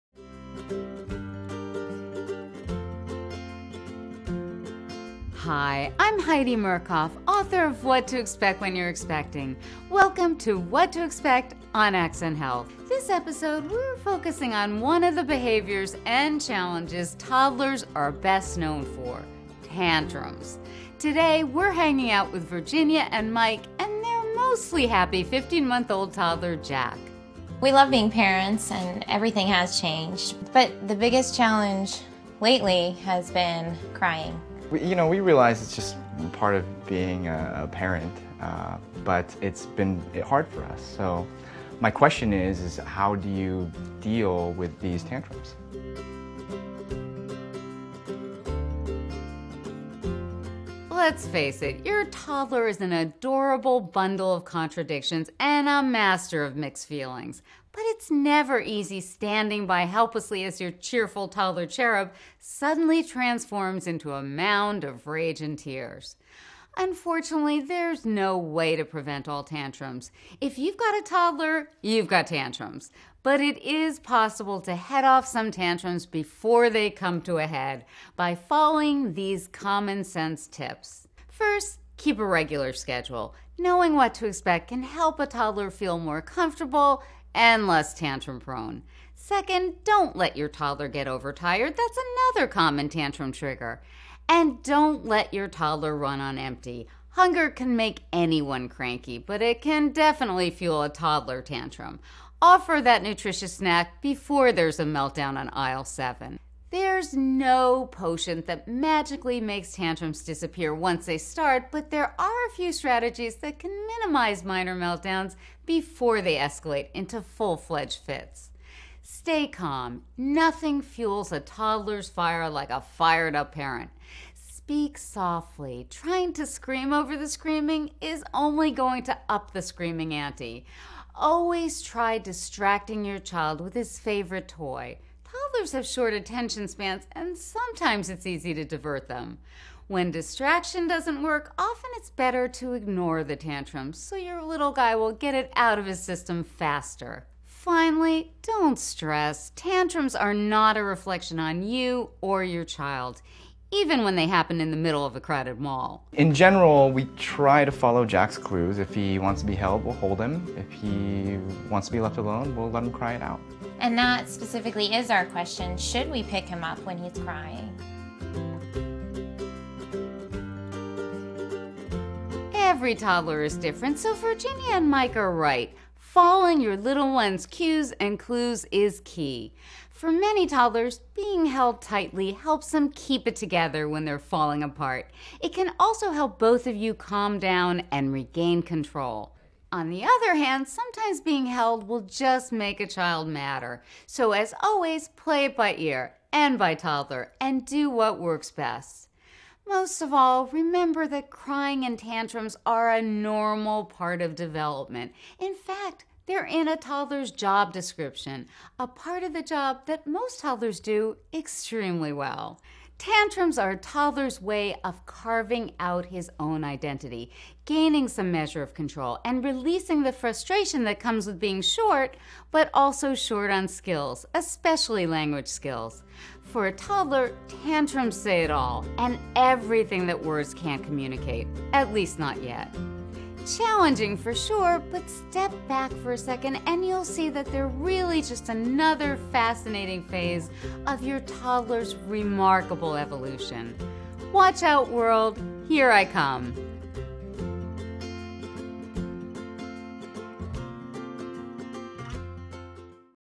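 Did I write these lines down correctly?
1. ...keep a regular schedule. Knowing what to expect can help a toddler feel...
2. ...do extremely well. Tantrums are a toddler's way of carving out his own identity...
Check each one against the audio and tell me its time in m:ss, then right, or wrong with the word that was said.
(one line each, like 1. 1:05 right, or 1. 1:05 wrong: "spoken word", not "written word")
1. 1:21 right
2. 3:30 right.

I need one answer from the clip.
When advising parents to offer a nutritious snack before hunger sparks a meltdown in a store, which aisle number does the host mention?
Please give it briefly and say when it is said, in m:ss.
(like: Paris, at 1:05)
7, at 1:45.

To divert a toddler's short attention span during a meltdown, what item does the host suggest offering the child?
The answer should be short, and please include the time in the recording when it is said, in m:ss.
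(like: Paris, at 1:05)
His favorite toy, at 2:13.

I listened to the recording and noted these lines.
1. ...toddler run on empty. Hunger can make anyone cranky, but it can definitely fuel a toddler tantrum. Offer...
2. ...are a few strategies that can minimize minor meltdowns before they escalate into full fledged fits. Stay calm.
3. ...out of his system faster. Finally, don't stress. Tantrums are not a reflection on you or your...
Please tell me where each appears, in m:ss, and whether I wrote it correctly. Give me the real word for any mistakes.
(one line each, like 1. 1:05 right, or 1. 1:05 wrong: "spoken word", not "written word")
1. 1:35 right
2. 1:52 right
3. 2:25 right.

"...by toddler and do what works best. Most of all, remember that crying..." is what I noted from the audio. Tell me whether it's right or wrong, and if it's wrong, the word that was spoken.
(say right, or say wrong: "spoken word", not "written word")
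right.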